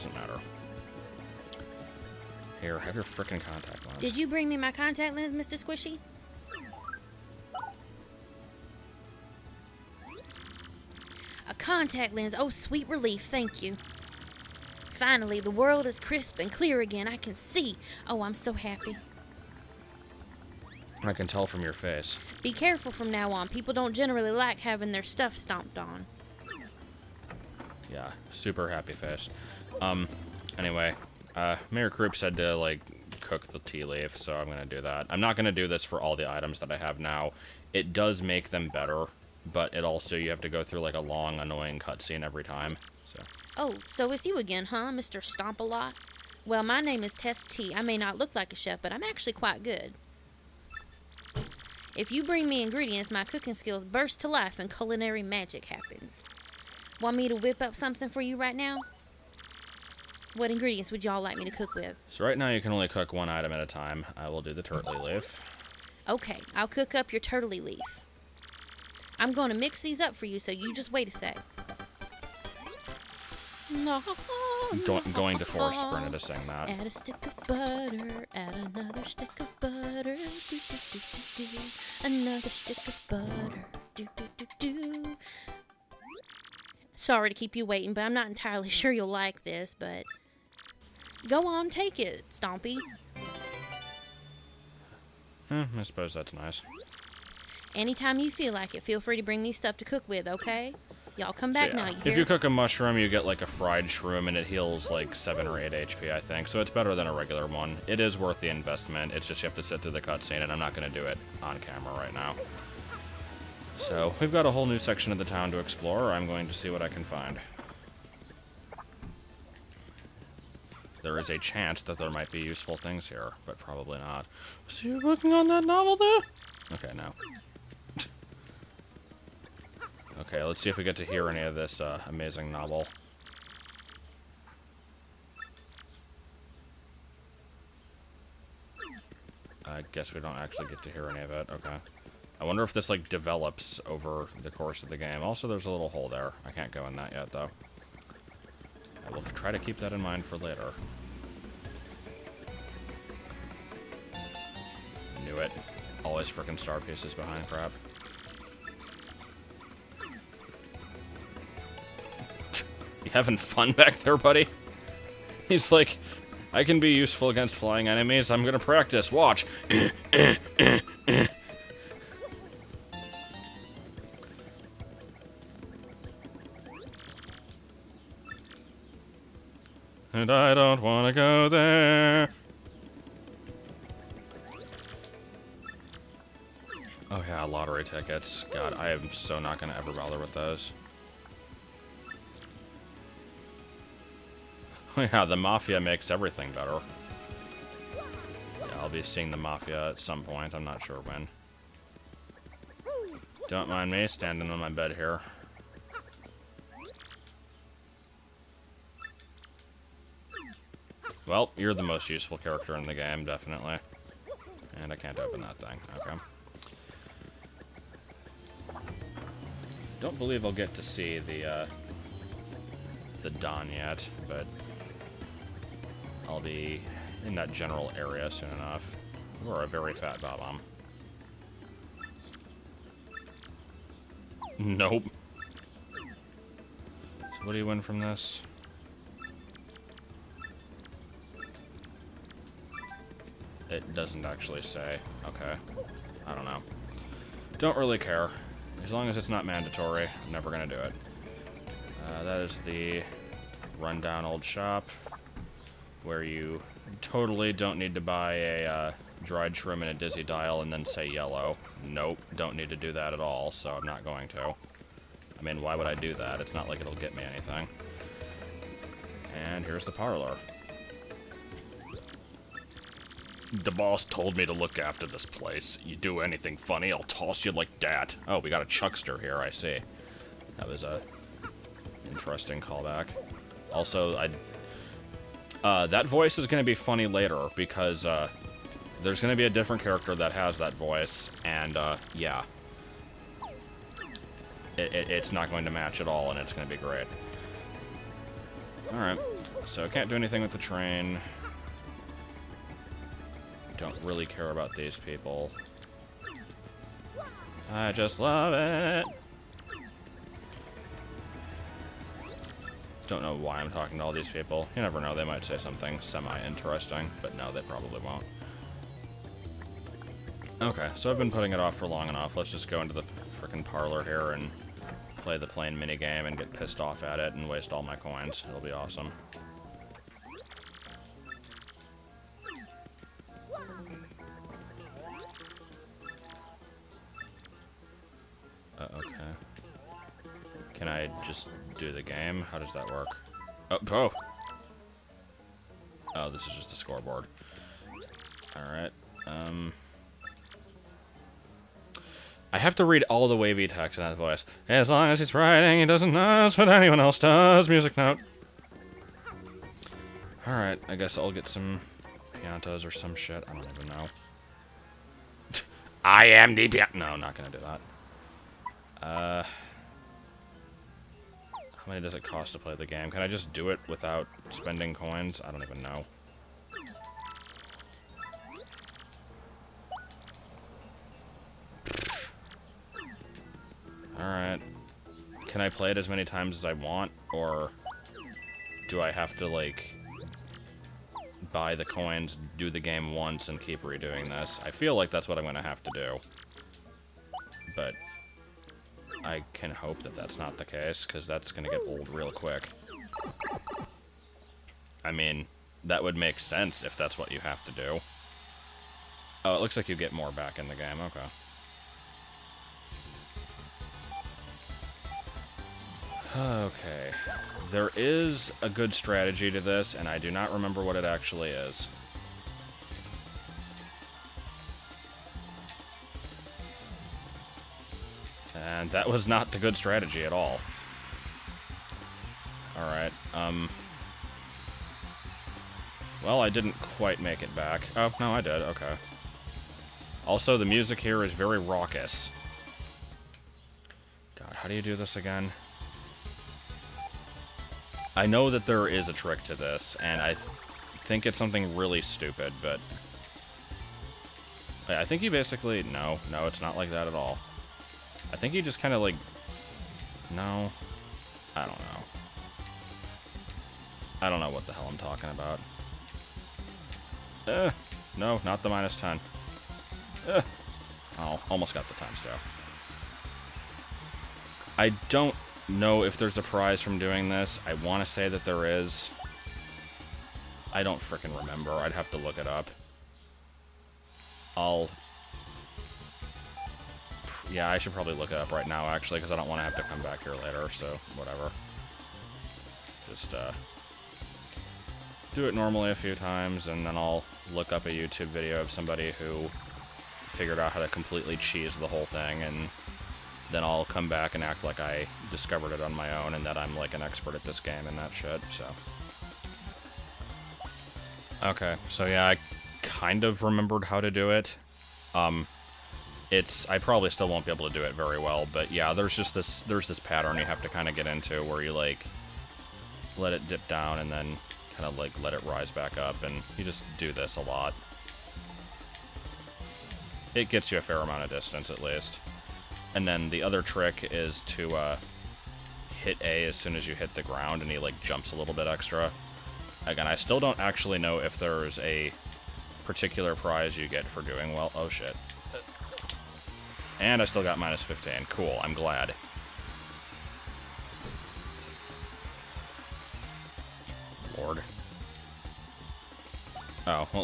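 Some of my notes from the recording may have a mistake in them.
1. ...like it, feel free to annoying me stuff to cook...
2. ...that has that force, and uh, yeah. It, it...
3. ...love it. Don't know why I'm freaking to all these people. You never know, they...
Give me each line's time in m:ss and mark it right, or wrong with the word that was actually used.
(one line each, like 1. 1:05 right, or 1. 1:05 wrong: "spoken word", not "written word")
1. 1:38 wrong: "bring", not "annoying"
2. 4:50 wrong: "voice", not "force"
3. 5:08 wrong: "talking", not "freaking".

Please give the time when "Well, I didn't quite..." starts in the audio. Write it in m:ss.
7:16.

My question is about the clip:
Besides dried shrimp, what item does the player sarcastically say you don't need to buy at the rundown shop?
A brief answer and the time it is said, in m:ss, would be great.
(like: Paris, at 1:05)
Dizzy dial, at 4:19.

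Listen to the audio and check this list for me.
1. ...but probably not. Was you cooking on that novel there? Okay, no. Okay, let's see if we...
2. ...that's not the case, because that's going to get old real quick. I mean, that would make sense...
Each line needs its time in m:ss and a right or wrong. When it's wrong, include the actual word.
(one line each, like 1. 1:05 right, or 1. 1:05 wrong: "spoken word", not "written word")
1. 2:03 wrong: "working", not "cooking"
2. 6:40 right.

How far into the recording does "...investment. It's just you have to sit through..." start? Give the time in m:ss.
1:48.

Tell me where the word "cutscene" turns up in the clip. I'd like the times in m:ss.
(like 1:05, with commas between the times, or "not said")
0:41, 1:50.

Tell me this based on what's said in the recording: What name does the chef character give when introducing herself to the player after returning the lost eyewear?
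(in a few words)
Zess T.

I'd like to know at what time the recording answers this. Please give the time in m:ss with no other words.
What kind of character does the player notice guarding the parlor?
4:38.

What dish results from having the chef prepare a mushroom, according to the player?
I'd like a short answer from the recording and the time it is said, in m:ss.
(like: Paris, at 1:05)
Fried shroom, at 1:43.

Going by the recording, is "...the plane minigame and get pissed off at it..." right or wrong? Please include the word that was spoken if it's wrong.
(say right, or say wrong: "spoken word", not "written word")
right.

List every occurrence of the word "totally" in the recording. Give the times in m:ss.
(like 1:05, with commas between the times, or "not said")
4:17.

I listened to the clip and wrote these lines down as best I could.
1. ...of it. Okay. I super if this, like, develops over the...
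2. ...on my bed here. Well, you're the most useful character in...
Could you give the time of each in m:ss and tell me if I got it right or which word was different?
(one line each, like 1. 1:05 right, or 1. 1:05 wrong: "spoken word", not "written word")
1. 2:21 wrong: "wonder", not "super"
2. 3:24 right.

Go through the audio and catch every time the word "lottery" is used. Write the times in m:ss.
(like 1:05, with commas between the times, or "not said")
3:07.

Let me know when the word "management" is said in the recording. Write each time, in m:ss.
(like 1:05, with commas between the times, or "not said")
not said.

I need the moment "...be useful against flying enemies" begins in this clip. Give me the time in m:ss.
2:46.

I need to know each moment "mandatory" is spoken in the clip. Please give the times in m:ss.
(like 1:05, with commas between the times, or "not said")
4:09.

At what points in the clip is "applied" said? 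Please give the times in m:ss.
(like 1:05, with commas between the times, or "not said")
not said.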